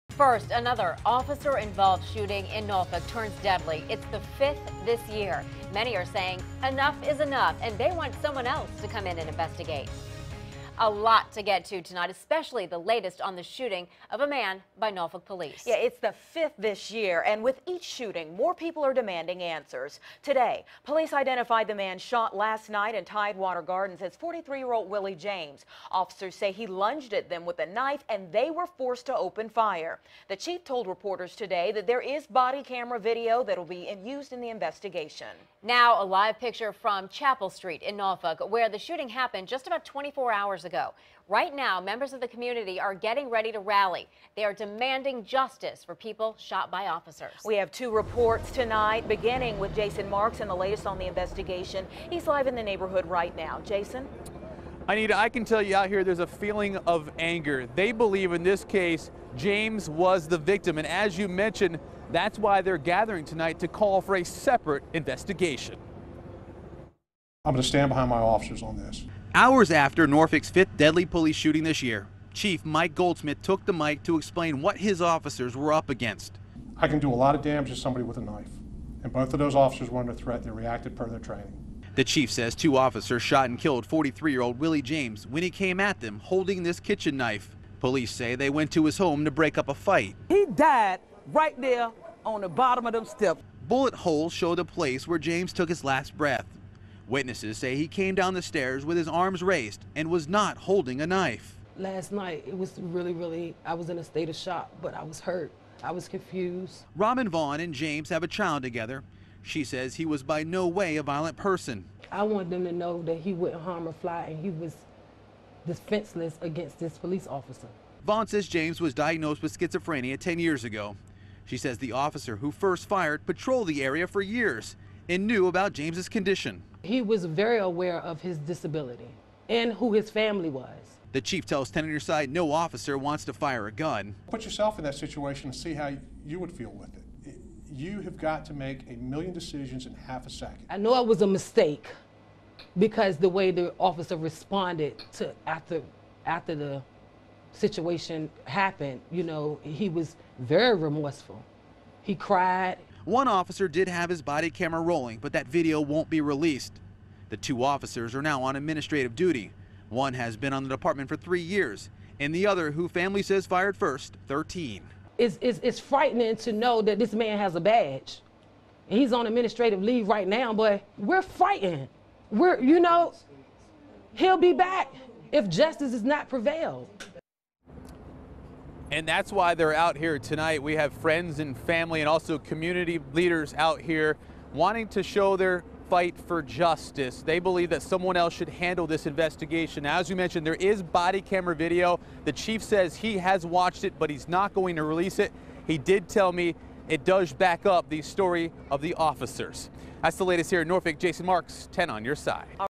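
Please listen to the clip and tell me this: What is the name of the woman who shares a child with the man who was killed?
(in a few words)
Robin Vaughn.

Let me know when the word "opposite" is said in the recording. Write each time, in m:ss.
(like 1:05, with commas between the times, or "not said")
not said.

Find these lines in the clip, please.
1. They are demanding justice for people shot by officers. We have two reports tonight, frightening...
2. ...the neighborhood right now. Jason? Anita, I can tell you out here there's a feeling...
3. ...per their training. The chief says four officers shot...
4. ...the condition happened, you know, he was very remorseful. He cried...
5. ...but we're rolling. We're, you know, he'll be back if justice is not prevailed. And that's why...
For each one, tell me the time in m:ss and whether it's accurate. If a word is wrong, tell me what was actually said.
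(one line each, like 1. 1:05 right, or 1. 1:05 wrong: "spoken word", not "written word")
1. 0:44 wrong: "beginning", not "frightening"
2. 0:52 right
3. 1:20 wrong: "two", not "four"
4. 2:26 wrong: "situation", not "condition"
5. 2:50 wrong: "fighting", not "rolling".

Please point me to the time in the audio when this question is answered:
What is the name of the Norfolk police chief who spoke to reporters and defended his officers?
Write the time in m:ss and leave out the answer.
1:12.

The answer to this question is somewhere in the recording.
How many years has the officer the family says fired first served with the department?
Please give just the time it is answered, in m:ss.
2:44.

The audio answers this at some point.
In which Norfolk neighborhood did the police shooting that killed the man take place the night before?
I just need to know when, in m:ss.
0:23.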